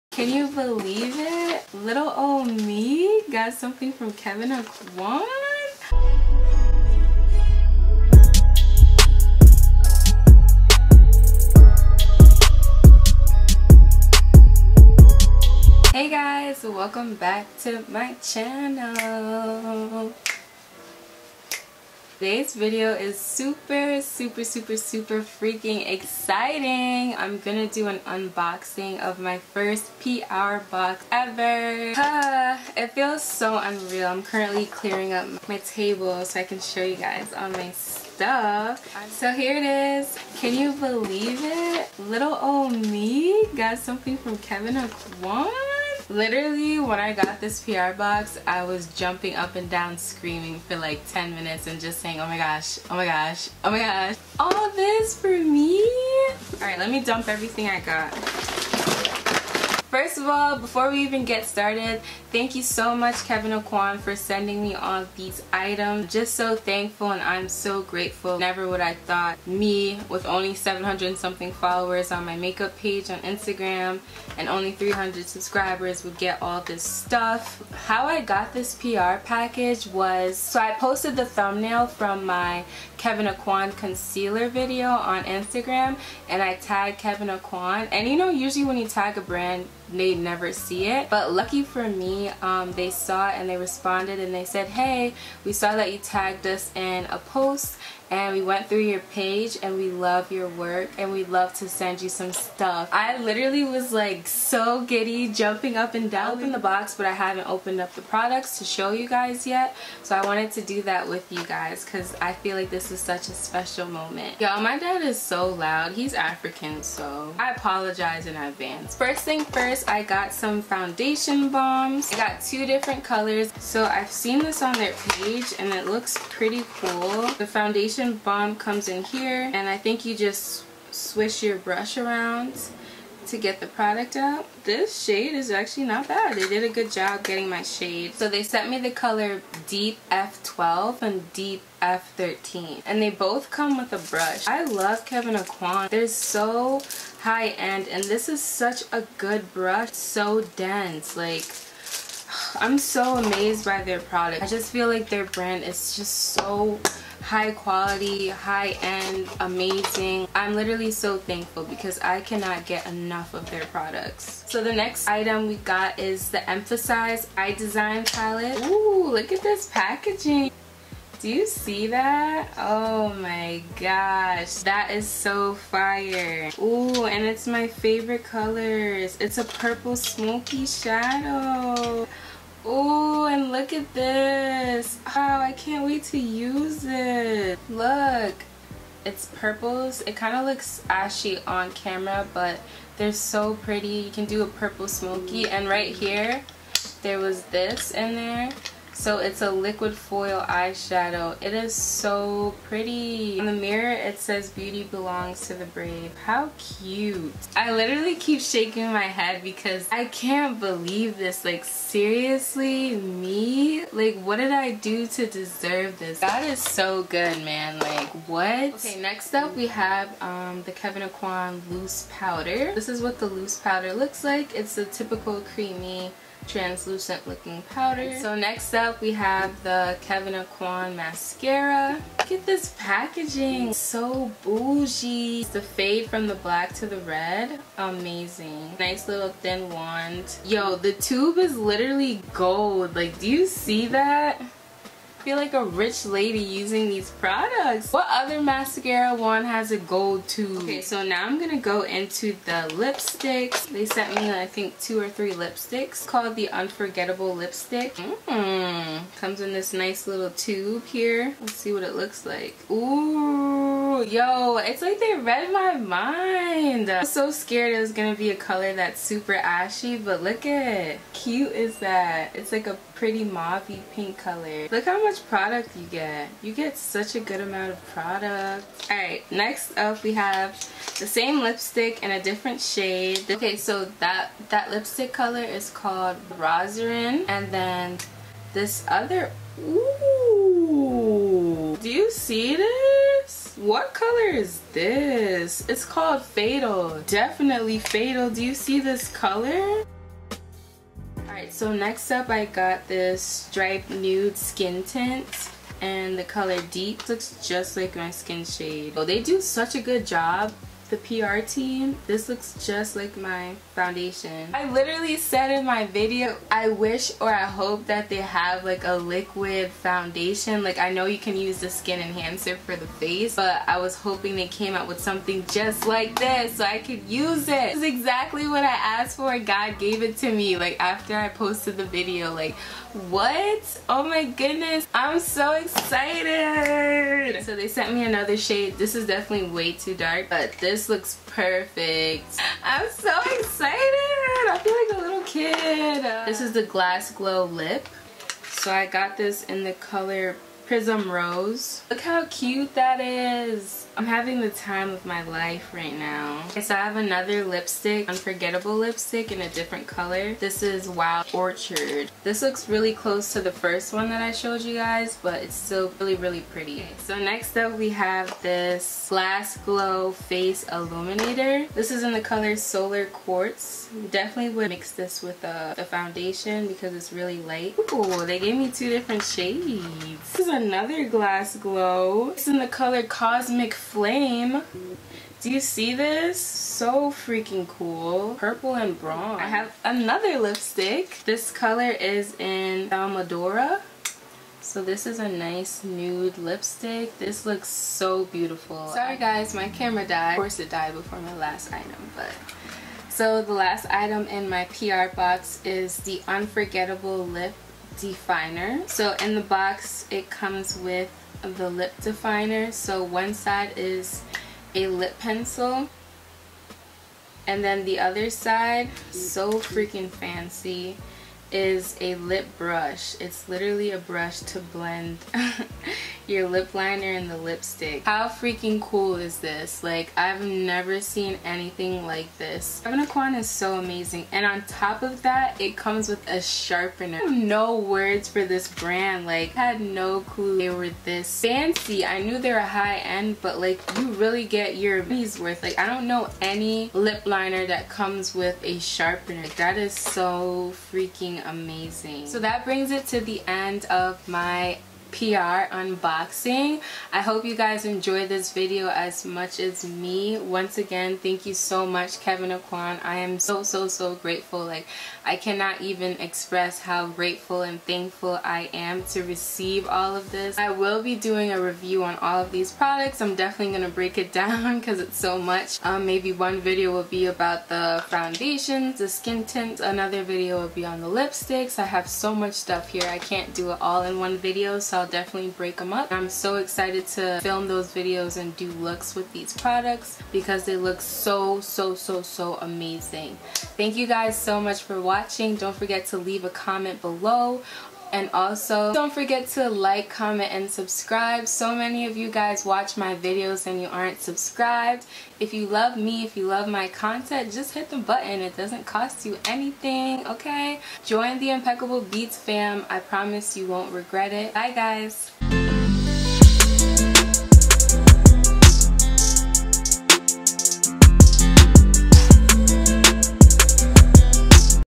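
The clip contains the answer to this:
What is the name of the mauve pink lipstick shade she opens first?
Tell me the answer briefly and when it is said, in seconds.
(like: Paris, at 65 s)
Rosarin, at 286 s.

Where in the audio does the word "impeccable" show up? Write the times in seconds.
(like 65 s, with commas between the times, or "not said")
511 s.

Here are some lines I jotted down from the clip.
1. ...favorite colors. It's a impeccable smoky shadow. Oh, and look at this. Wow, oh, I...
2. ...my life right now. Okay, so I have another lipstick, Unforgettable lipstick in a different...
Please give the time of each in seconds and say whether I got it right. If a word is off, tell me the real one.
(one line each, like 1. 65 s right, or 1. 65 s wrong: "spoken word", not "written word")
1. 177 s wrong: "purple", not "impeccable"
2. 355 s right.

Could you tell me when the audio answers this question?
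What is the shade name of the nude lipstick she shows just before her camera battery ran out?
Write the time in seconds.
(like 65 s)
392 s.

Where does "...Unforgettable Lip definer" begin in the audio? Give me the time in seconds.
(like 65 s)
406 s.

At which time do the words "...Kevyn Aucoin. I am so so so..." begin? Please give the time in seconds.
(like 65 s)
462 s.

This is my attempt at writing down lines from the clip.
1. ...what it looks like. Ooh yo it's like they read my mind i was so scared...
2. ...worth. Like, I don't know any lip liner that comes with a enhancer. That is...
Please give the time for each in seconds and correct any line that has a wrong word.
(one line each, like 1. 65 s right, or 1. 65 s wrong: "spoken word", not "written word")
1. 261 s right
2. 445 s wrong: "sharpener", not "enhancer".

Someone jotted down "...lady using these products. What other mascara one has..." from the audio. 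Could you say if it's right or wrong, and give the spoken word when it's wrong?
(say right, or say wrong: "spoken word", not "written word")
right.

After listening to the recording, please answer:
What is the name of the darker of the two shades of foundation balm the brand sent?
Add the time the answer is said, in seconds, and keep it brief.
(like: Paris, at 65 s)
Deep F13, at 141 s.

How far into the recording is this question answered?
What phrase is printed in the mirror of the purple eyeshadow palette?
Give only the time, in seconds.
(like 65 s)
204 s.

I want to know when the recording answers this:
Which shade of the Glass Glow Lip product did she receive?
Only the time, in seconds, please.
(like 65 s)
350 s.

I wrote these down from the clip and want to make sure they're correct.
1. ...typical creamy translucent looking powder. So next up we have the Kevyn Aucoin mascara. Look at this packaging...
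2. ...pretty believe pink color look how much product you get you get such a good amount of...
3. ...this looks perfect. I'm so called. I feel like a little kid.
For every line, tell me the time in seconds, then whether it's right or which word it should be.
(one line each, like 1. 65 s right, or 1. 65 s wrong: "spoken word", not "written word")
1. 224 s right
2. 272 s wrong: "mauve", not "believe"
3. 340 s wrong: "excited", not "called".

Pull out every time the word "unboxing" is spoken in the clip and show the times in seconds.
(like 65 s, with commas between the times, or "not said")
28 s, 455 s.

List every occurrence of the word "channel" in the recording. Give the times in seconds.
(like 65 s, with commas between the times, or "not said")
18 s.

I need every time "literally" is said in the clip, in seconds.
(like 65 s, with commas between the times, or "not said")
46 s, 103 s, 160 s, 207 s, 241 s, 314 s, 423 s.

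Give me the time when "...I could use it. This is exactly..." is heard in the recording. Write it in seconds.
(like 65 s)
326 s.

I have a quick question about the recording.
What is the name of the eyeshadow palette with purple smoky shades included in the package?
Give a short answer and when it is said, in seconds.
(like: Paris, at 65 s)
Emphasize Eye Design Palette, at 166 s.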